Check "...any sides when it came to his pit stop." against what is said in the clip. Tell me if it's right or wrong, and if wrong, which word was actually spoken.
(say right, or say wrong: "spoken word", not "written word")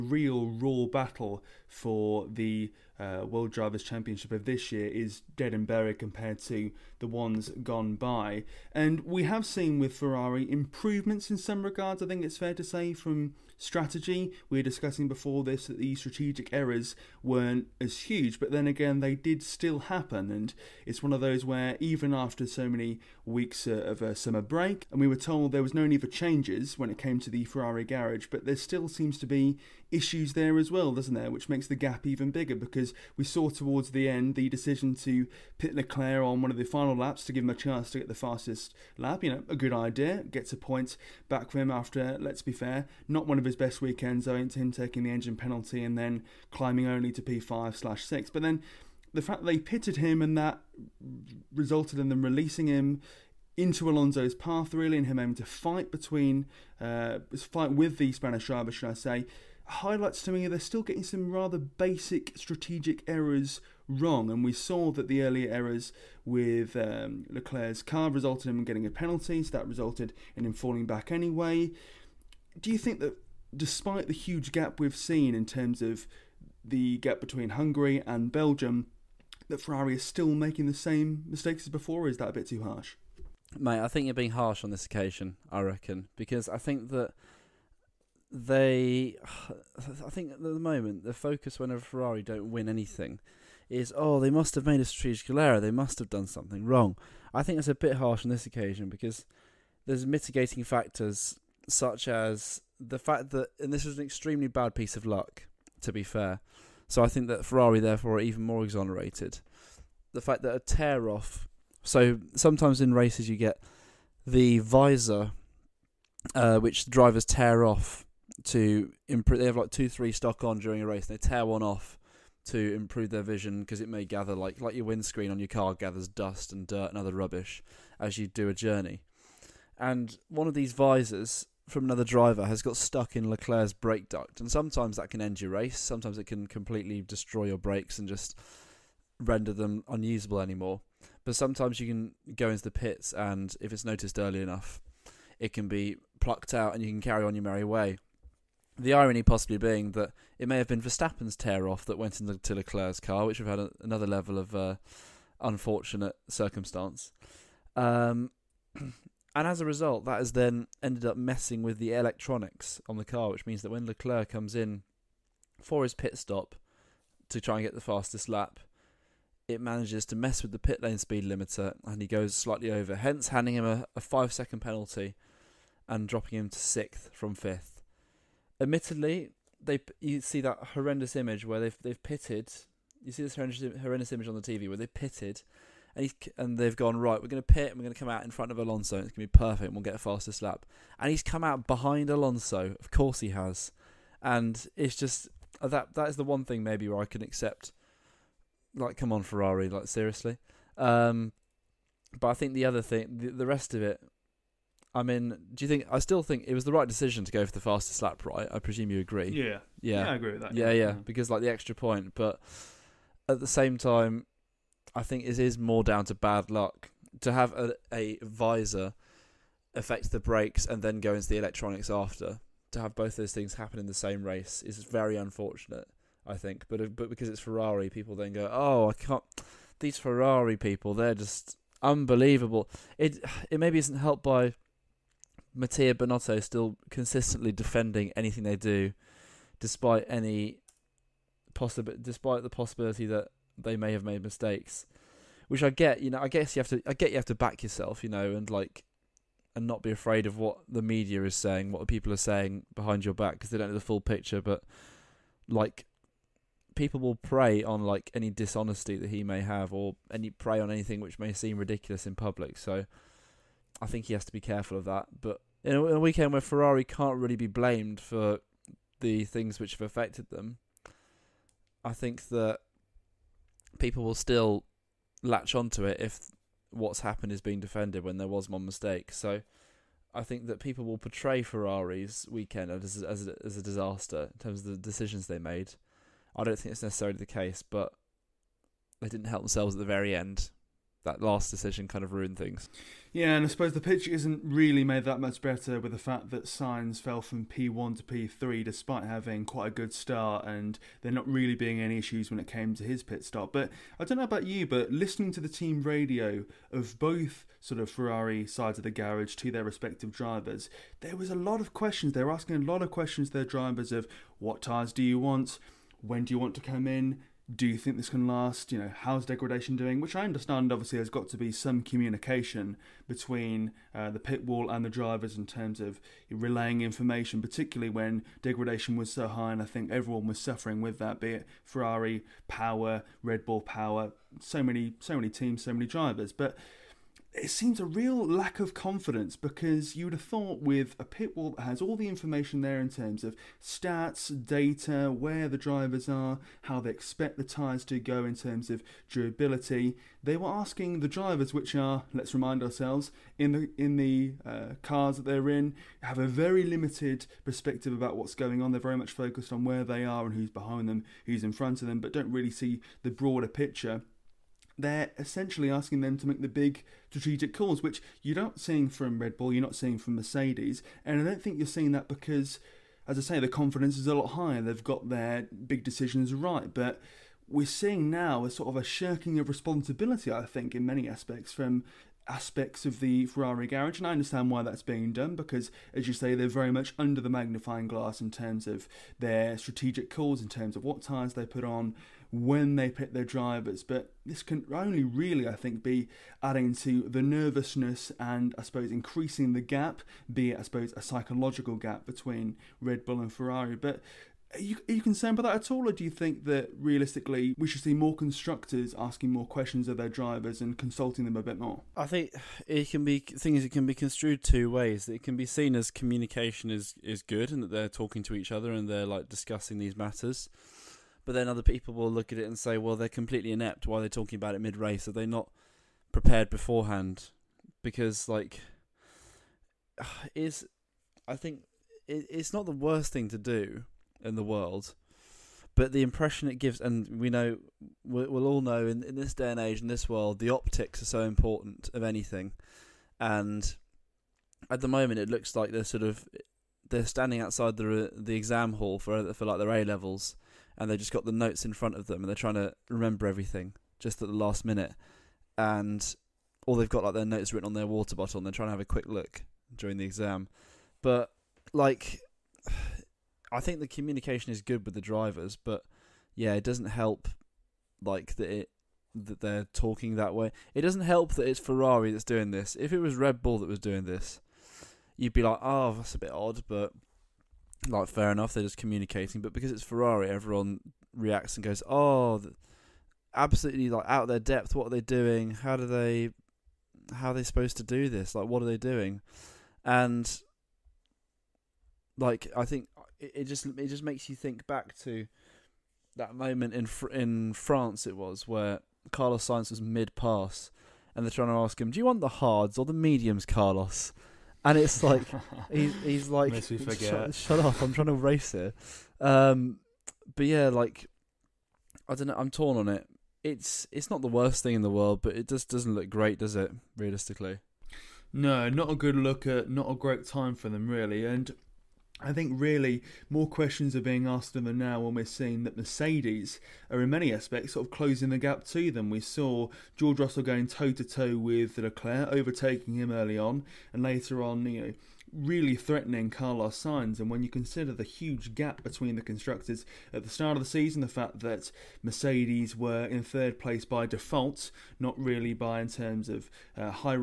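wrong: "issues", not "sides".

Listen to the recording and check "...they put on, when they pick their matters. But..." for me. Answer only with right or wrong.
wrong.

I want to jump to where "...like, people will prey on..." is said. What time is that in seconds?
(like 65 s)
255 s.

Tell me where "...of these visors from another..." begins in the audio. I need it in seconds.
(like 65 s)
130 s.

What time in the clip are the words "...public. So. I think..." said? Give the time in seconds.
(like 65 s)
262 s.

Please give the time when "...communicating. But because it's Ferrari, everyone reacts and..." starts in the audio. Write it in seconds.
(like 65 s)
478 s.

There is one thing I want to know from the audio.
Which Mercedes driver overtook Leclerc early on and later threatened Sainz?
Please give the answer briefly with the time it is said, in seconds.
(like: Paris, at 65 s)
George Russell, at 529 s.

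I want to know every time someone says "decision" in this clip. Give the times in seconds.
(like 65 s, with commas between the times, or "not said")
34 s, 206 s, 284 s, 291 s, 375 s.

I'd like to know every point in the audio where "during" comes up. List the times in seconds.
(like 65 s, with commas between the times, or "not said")
120 s, 459 s.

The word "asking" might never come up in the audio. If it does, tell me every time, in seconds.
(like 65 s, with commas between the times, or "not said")
312 s, 350 s, 365 s, 408 s.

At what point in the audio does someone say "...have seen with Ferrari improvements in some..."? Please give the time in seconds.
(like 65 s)
9 s.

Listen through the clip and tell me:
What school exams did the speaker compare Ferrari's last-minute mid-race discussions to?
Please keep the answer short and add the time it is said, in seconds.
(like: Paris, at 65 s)
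A levels, at 449 s.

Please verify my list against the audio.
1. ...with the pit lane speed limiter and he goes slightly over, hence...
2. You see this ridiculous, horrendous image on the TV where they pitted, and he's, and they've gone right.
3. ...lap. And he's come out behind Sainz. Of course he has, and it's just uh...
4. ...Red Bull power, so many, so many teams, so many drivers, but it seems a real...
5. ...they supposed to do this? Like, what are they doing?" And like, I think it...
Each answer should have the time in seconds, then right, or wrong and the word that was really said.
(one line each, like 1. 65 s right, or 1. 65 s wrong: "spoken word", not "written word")
1. 170 s right
2. 183 s wrong: "horrendous", not "ridiculous"
3. 190 s wrong: "Alonso", not "Sainz"
4. 333 s right
5. 487 s right.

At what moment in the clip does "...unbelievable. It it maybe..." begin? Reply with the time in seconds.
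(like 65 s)
231 s.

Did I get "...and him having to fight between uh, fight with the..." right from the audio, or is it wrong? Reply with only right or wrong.
right.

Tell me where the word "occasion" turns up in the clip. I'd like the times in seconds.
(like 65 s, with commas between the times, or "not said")
84 s, 98 s.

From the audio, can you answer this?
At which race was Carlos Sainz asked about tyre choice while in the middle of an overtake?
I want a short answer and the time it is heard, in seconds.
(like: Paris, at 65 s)
France, at 497 s.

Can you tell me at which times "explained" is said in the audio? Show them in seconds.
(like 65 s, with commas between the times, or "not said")
not said.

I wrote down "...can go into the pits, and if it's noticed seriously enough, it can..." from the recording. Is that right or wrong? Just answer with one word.
wrong.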